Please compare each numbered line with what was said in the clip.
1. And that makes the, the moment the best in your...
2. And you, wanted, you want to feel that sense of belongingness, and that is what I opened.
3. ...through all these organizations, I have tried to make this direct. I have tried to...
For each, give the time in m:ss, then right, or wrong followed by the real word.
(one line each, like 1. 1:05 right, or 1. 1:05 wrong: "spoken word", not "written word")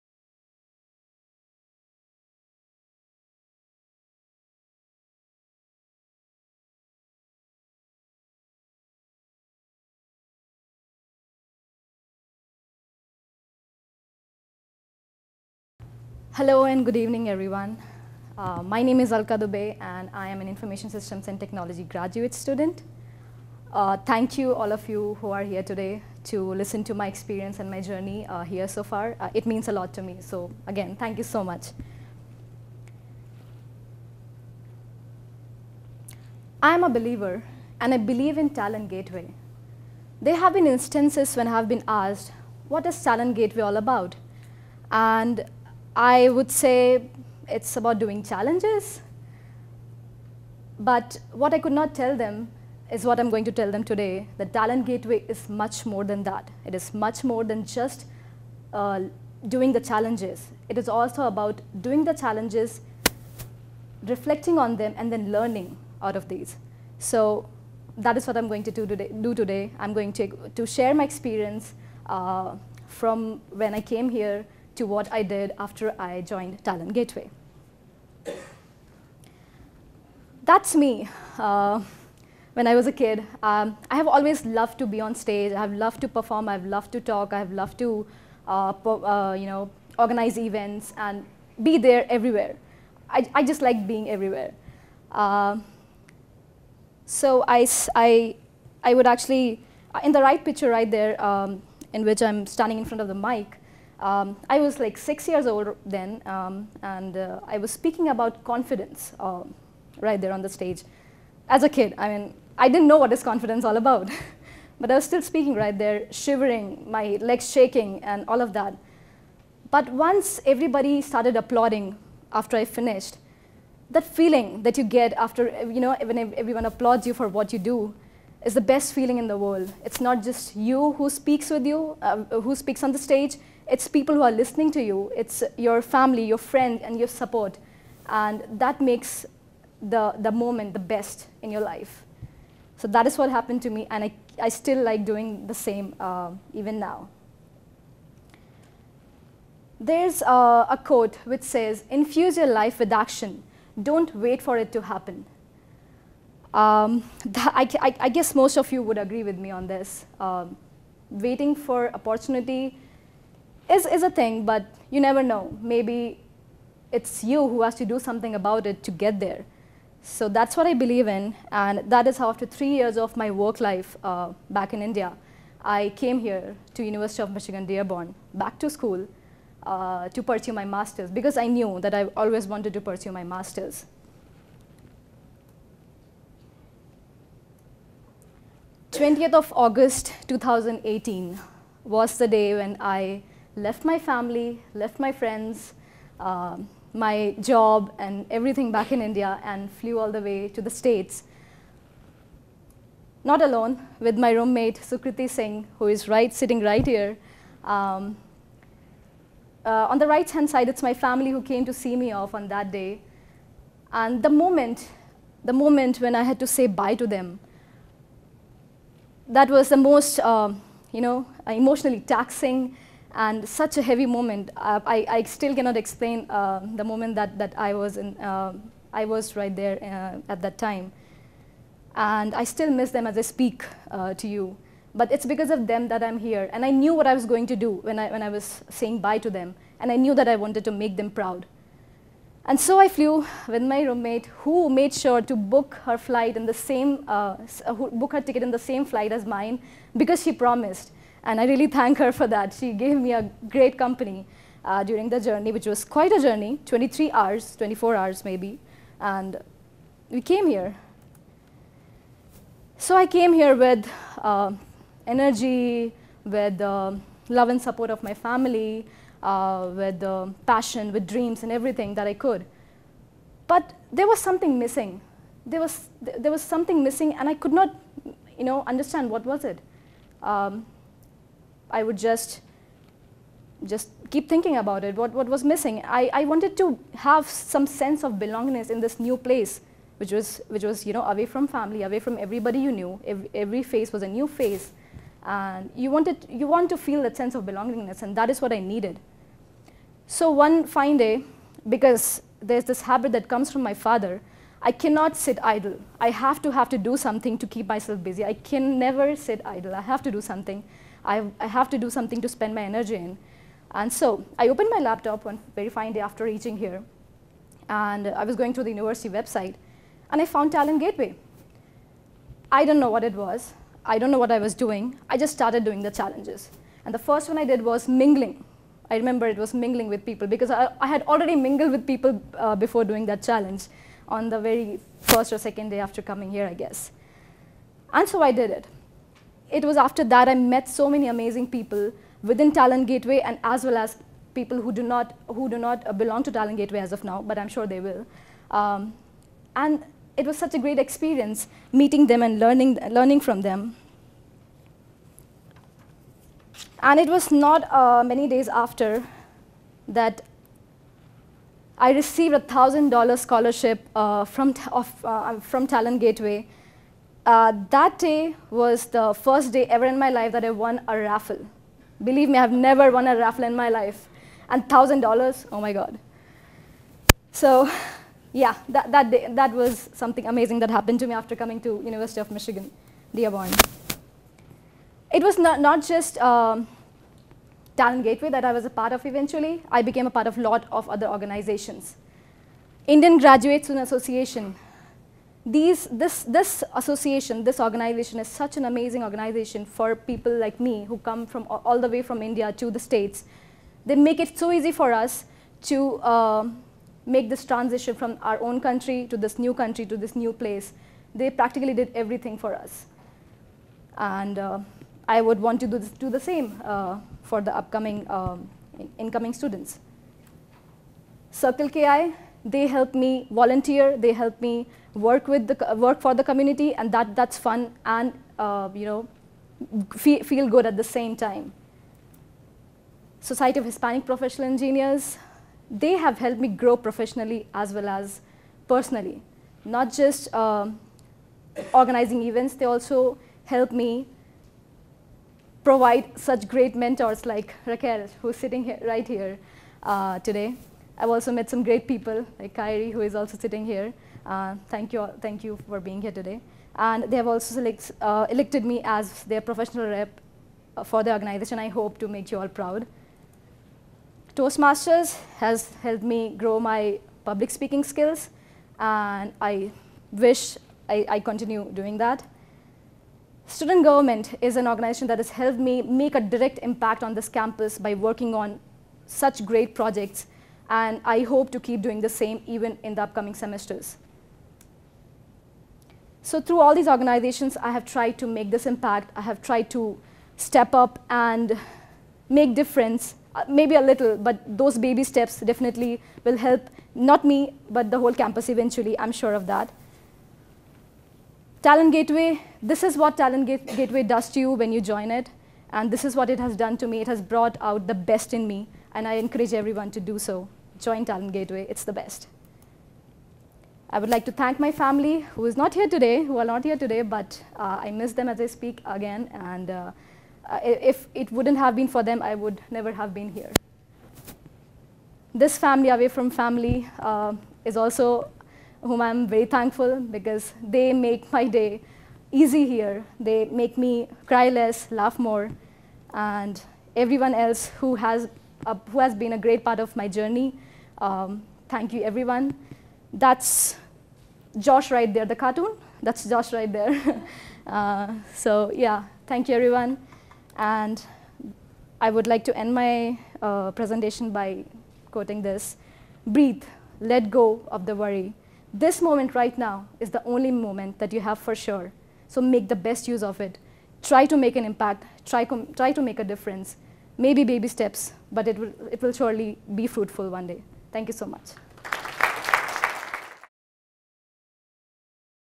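1. 2:18 right
2. 4:55 wrong: "needed", not "opened"
3. 8:06 wrong: "impact", not "direct".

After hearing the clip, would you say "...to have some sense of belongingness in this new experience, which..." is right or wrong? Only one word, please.
wrong.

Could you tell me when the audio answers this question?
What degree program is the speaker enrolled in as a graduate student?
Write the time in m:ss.
0:20.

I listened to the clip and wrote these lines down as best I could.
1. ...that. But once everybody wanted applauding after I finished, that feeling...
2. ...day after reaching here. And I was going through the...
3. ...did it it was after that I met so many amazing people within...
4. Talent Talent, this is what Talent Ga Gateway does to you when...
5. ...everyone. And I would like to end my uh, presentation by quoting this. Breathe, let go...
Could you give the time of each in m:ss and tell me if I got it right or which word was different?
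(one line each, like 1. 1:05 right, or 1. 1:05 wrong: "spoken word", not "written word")
1. 1:58 wrong: "started", not "wanted"
2. 5:15 right
3. 5:38 right
4. 8:21 wrong: "Gateway", not "Talent"
5. 9:09 right.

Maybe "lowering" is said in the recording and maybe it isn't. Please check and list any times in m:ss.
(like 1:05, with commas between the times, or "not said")
not said.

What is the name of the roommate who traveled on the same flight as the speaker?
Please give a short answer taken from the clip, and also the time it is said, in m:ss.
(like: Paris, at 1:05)
Sukriti Singh, at 3:24.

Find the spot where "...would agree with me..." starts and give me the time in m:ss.
2:38.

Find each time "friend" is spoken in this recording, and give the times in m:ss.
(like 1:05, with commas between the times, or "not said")
2:16, 3:15.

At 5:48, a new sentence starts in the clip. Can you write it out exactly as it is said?
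Um, and it was such a great experience meeting them and learning, learning from them.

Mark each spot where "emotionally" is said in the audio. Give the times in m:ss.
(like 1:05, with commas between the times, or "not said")
3:41.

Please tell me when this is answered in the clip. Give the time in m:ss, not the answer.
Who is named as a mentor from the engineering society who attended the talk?
7:27.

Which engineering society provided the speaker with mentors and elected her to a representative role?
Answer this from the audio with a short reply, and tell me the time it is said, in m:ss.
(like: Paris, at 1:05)
Society of Hispanic Professional Engineers, at 7:13.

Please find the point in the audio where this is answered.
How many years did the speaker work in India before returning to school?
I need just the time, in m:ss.
2:52.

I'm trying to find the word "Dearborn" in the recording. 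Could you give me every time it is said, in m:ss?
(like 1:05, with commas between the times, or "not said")
2:57, 6:23.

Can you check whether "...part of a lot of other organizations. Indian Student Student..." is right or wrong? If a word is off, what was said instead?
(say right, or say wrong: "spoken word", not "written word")
wrong: "Graduate", not "Student".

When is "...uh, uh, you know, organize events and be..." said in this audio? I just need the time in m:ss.
1:28.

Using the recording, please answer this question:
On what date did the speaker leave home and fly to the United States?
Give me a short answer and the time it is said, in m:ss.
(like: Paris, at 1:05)
20 August 2018, at 3:08.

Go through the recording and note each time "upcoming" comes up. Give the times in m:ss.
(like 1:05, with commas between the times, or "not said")
6:57, 8:03.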